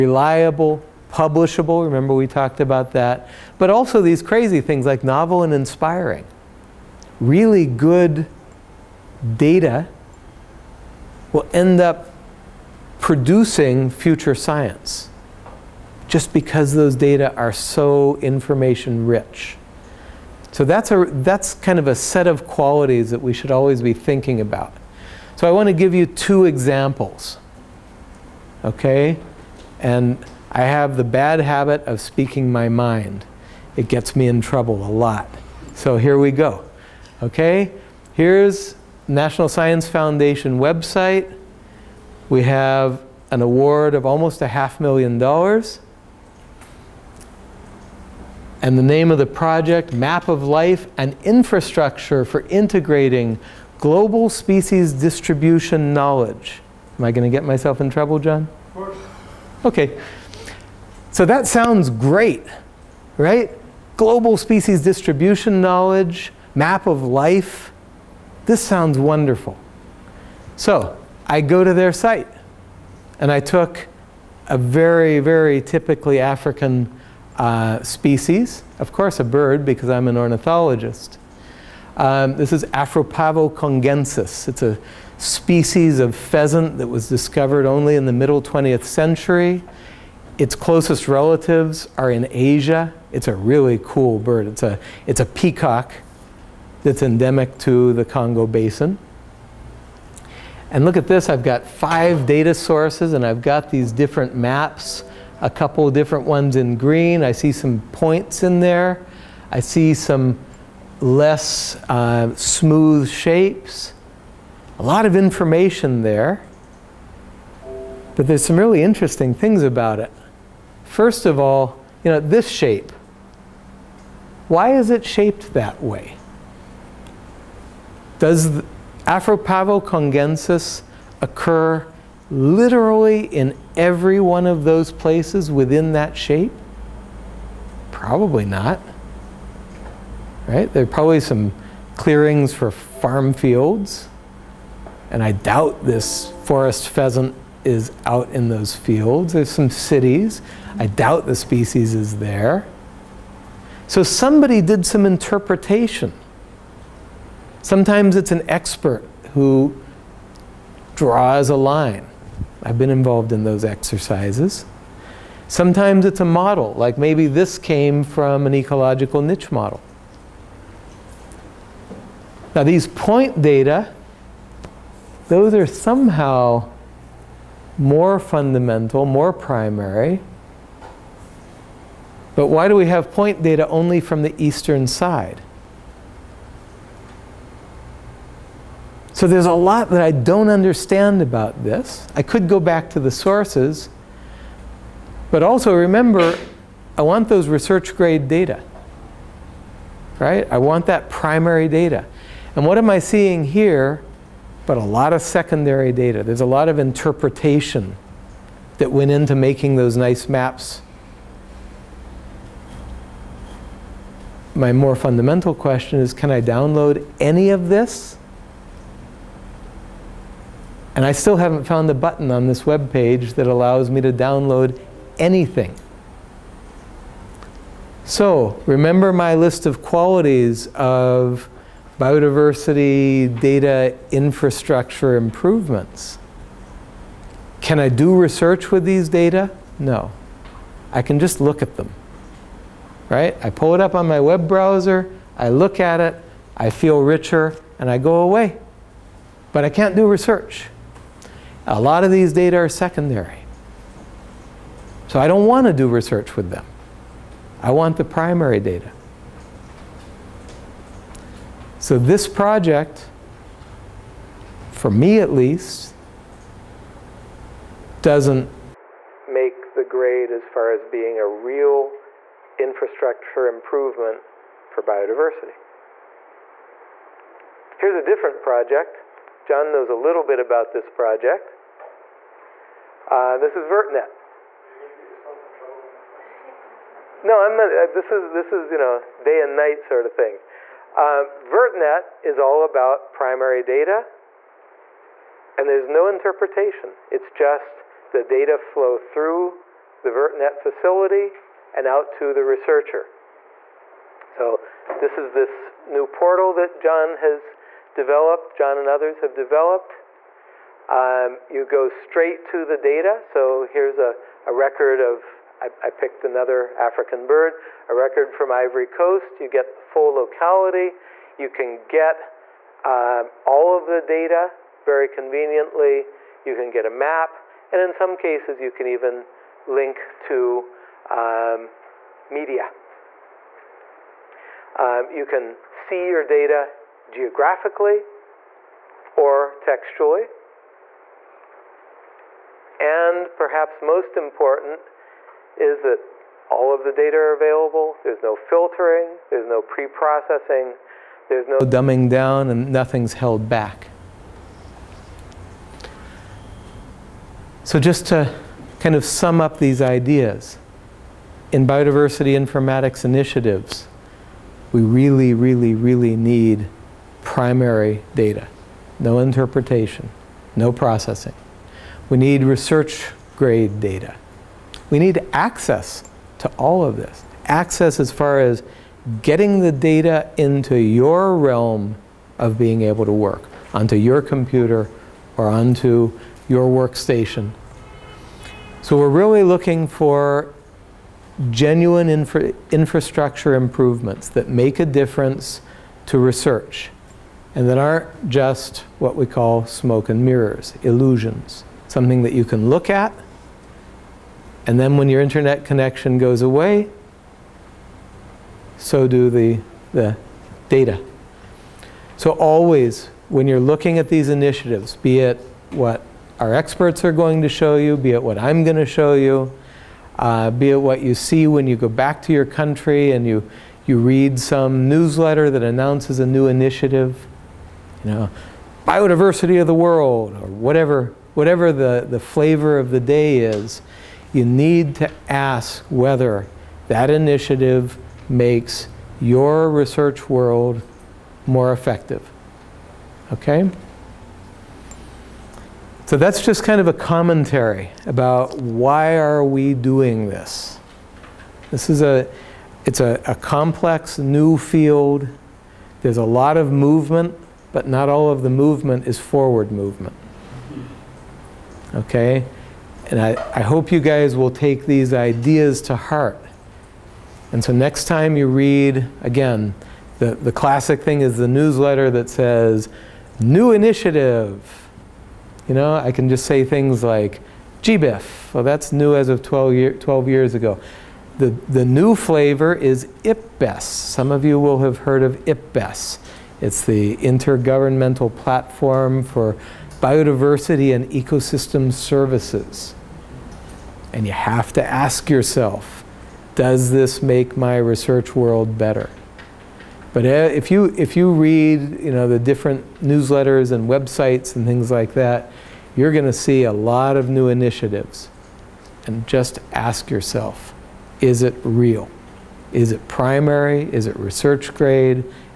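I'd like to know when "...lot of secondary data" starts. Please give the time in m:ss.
3:24.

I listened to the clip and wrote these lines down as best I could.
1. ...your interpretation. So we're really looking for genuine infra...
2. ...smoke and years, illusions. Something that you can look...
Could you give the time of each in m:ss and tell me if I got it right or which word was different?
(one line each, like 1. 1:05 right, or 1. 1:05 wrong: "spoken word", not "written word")
1. 6:26 wrong: "workstation", not "interpretation"
2. 6:39 wrong: "mirrors", not "years".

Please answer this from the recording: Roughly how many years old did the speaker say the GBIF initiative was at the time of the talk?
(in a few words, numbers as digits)
12.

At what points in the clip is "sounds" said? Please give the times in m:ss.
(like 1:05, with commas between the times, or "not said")
1:01, 1:08.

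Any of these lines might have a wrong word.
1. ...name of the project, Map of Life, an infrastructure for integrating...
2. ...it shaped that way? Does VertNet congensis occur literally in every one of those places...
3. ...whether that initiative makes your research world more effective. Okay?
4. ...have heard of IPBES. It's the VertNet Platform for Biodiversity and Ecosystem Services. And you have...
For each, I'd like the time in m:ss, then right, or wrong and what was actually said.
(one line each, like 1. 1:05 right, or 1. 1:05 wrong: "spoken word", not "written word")
1. 0:48 right
2. 2:04 wrong: "Afropavo", not "VertNet"
3. 7:15 right
4. 8:04 wrong: "Intergovernmental", not "VertNet".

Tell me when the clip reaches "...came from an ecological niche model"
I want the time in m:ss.
2:47.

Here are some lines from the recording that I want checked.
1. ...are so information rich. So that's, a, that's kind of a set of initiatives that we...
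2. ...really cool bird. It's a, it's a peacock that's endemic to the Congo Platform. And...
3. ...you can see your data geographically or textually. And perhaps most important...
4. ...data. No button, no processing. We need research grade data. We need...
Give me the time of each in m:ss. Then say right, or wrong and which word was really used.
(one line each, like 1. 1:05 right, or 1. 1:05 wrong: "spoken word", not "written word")
1. 0:17 wrong: "qualities", not "initiatives"
2. 1:33 wrong: "Basin", not "Platform"
3. 5:35 right
4. 6:08 wrong: "interpretation", not "button".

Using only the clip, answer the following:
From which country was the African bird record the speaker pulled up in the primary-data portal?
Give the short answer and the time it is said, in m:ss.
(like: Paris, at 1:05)
Ivory Coast, at 5:18.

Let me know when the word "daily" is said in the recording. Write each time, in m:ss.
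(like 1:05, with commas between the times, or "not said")
not said.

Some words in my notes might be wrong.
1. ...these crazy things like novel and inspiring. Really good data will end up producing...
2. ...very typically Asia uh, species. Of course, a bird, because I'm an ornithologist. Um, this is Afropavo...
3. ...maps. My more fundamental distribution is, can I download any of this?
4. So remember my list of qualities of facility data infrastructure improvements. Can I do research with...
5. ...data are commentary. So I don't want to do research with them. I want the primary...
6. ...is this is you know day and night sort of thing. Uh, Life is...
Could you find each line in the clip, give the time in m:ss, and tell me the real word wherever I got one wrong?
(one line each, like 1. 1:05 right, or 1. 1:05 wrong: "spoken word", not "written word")
1. 0:04 right
2. 1:15 wrong: "African", not "Asia"
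3. 3:30 wrong: "question", not "distribution"
4. 3:48 wrong: "biodiversity", not "facility"
5. 4:12 wrong: "secondary", not "commentary"
6. 4:48 wrong: "VertNet", not "Life".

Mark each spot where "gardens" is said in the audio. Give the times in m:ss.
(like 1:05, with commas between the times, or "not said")
not said.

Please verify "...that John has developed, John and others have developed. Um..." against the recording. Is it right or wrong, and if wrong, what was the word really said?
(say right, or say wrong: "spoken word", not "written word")
right.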